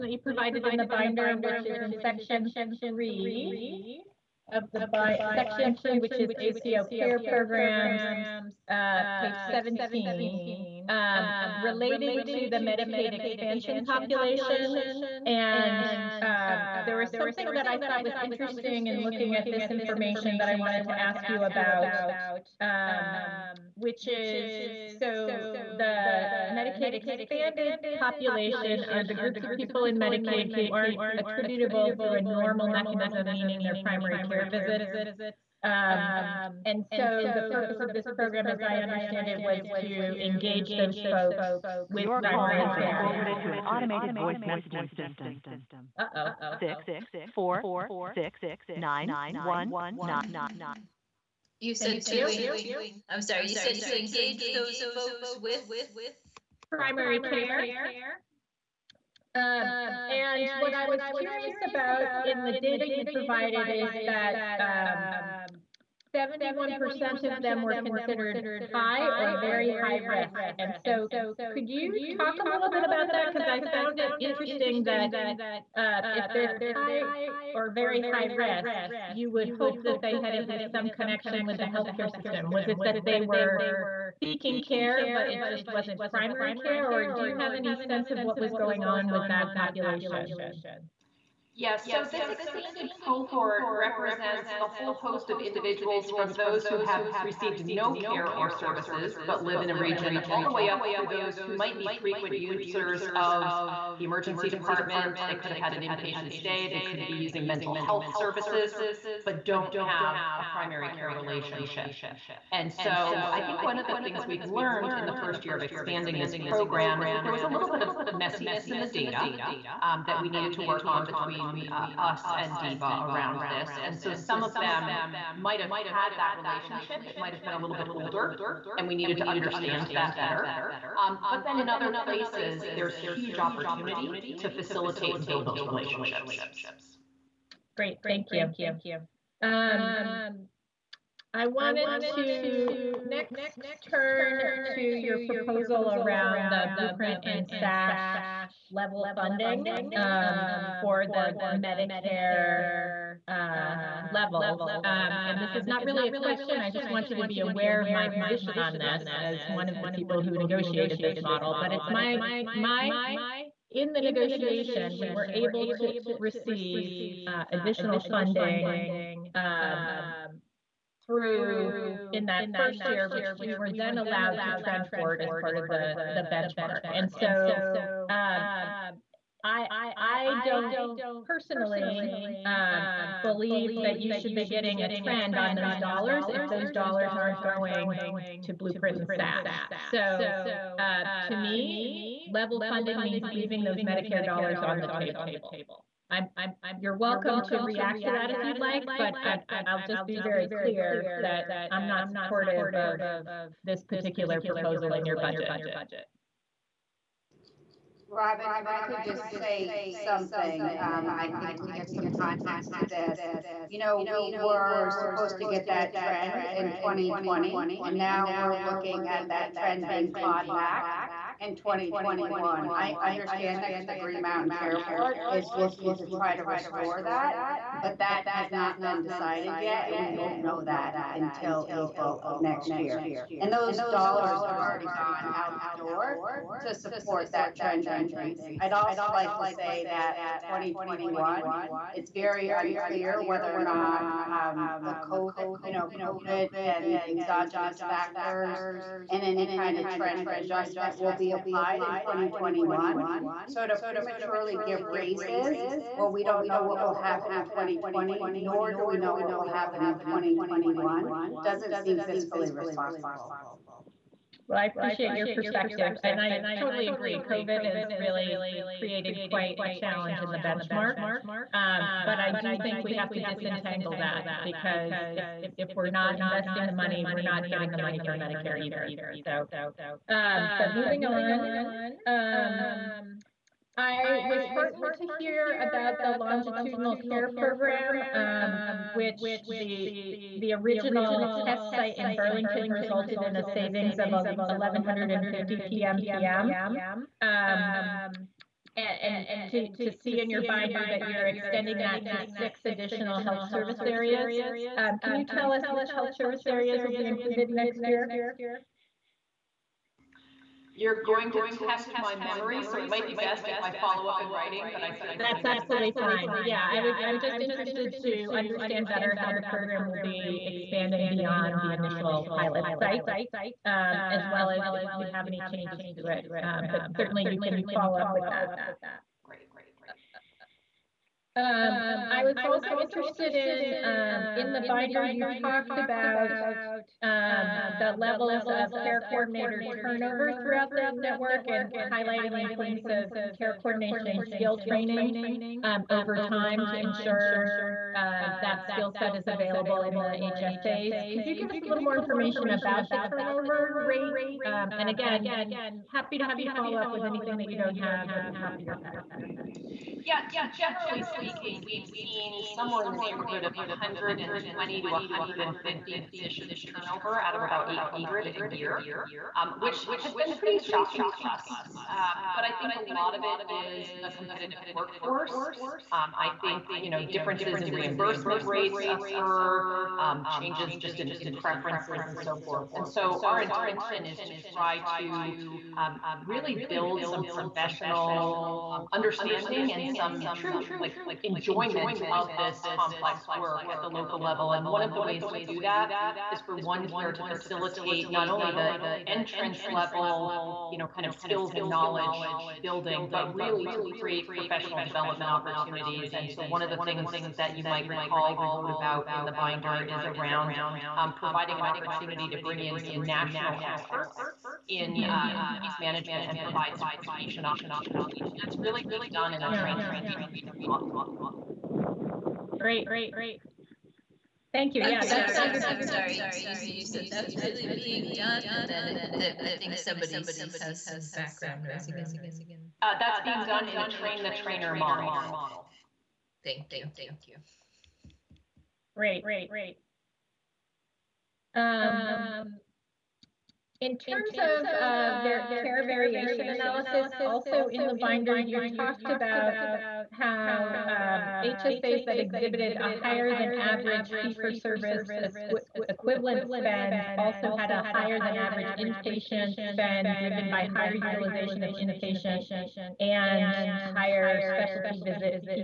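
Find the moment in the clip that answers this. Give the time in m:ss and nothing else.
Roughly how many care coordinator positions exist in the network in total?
6:07.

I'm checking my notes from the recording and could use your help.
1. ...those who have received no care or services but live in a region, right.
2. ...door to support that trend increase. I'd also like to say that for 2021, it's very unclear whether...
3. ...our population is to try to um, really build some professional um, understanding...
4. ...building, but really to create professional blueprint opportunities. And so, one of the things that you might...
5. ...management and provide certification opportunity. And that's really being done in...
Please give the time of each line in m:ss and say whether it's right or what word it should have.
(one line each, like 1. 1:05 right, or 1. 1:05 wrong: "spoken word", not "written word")
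1. 1:36 right
2. 3:55 right
3. 6:23 wrong: "intention", not "population"
4. 6:42 wrong: "development", not "blueprint"
5. 6:55 right.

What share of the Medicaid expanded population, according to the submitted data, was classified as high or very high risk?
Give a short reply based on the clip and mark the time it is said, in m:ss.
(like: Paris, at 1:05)
71%, at 1:06.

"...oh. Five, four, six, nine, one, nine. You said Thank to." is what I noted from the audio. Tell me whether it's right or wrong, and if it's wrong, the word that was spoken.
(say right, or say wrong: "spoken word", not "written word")
wrong: "Six", not "Five".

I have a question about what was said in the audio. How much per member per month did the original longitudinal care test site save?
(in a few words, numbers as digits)
1150 PMPM.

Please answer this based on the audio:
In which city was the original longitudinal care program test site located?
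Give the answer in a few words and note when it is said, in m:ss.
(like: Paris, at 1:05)
Burlington, at 4:52.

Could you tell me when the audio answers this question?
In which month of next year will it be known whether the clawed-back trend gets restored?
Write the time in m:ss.
3:51.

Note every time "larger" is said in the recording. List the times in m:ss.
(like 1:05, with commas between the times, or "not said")
not said.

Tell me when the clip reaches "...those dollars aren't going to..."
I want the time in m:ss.
3:06.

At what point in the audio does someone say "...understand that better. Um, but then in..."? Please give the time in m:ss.
2:09.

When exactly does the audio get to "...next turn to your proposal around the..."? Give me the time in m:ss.
2:23.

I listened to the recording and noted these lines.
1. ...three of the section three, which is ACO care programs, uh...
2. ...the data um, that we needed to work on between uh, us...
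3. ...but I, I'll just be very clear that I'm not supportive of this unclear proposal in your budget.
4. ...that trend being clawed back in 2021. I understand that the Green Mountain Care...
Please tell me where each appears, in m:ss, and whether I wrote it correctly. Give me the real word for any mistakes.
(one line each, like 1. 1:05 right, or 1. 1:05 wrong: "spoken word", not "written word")
1. 0:02 right
2. 1:58 right
3. 3:18 wrong: "particular", not "unclear"
4. 3:39 right.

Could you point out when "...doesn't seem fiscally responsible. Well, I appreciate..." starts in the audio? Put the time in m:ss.
4:21.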